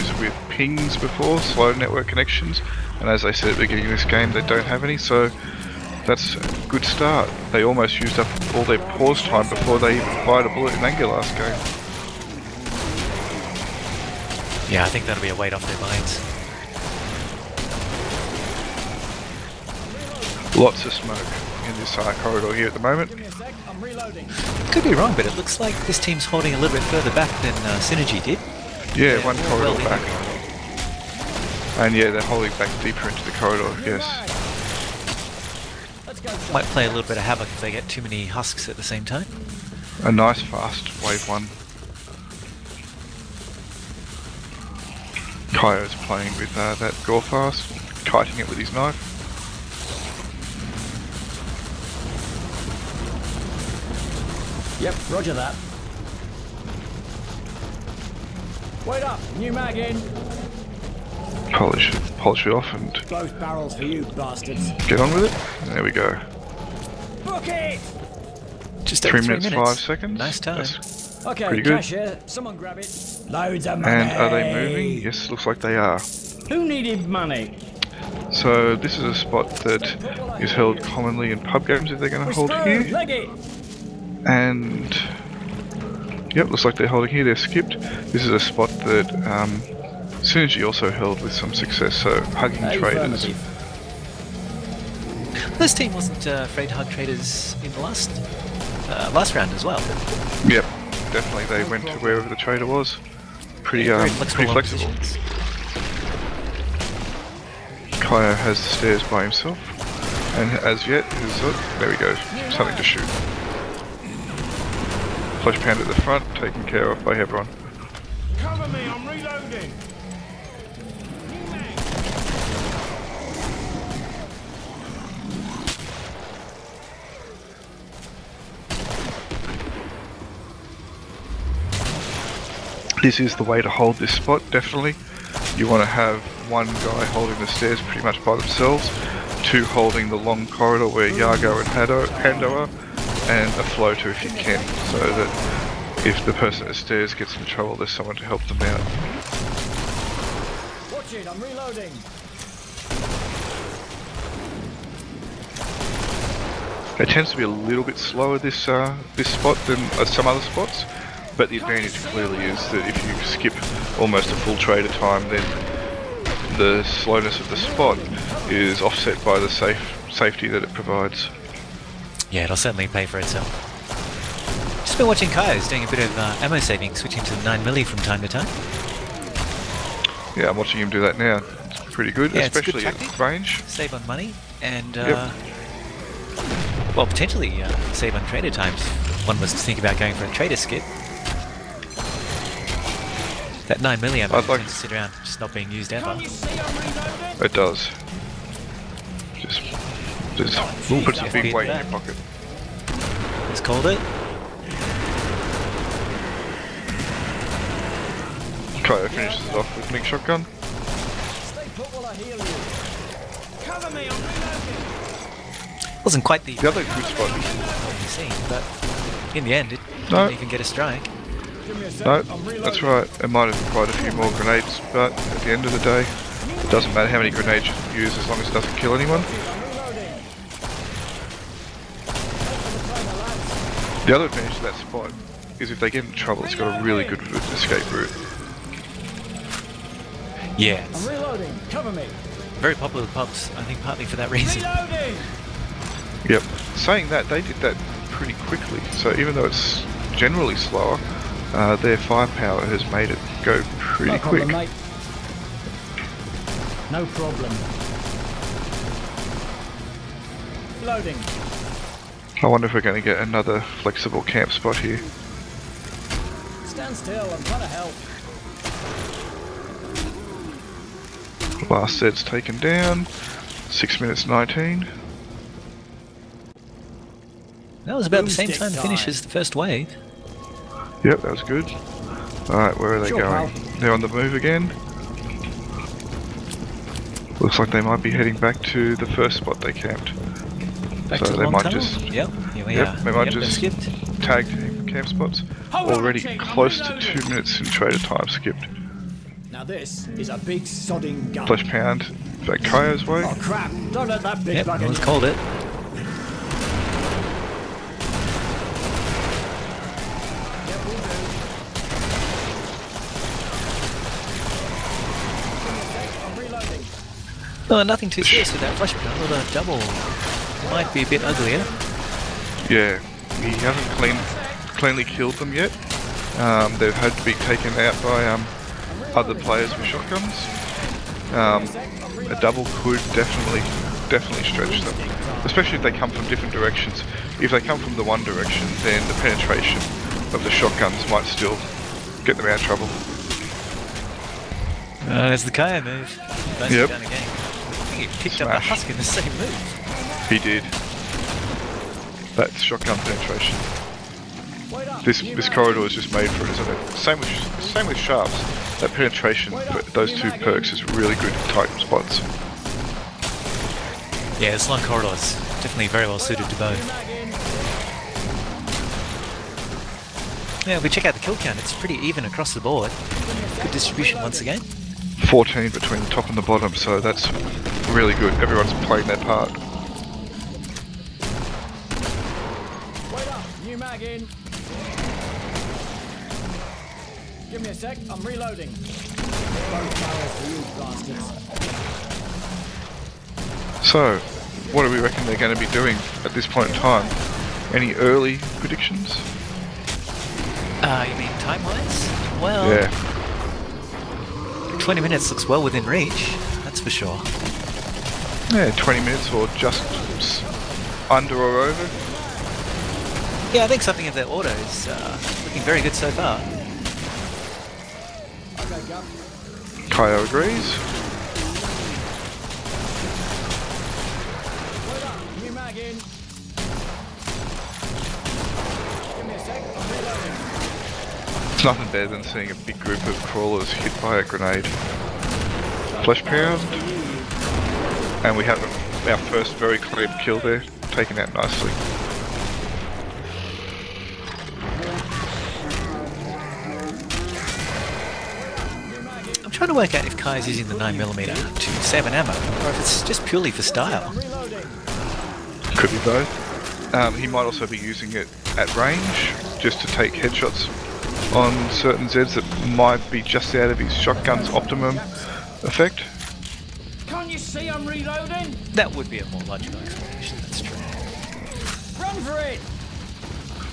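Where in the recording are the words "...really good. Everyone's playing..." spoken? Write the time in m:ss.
6:17.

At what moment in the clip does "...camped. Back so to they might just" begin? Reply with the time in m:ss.
4:49.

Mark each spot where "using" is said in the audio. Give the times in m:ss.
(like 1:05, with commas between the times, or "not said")
7:30, 7:37.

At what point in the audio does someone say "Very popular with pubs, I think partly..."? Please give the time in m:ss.
4:02.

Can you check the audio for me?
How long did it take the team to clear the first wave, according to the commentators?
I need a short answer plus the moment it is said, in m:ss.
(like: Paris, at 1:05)
3 minutes 5 seconds, at 1:09.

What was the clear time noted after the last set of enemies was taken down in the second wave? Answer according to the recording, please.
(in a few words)
6 minutes 19.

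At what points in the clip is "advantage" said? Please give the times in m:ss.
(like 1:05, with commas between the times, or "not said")
2:41, 3:54.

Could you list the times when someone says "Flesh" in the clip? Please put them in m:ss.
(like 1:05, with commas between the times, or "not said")
5:01, 7:16.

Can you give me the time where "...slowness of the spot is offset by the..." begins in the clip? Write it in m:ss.
2:46.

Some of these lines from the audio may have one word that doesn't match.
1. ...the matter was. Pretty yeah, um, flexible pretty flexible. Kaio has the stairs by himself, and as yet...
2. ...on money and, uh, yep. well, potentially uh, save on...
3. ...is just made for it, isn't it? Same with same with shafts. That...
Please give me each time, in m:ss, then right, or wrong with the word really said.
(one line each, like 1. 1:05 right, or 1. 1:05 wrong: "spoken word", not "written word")
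1. 1:42 wrong: "trader", not "matter"
2. 3:03 right
3. 5:55 right.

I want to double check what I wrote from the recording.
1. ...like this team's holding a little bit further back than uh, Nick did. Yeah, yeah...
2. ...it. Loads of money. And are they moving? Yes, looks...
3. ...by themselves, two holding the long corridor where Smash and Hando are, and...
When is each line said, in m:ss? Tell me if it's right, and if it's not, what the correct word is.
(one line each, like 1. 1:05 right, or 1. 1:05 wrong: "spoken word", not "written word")
1. 0:25 wrong: "Synergy", not "Nick"
2. 1:12 right
3. 2:18 wrong: "Yago", not "Smash".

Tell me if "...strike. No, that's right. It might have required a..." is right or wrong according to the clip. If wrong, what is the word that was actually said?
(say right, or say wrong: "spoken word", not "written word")
right.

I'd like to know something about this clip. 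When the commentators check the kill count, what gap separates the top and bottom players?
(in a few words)
14.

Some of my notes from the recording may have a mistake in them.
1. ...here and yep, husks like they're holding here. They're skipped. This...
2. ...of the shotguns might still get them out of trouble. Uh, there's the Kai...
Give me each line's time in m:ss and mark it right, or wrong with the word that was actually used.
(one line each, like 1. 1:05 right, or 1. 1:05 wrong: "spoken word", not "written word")
1. 1:22 wrong: "looks", not "husks"
2. 5:40 wrong: "Kaya", not "Kai".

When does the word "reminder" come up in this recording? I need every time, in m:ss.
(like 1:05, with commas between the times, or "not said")
not said.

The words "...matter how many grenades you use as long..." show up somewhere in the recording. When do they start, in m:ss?
3:46.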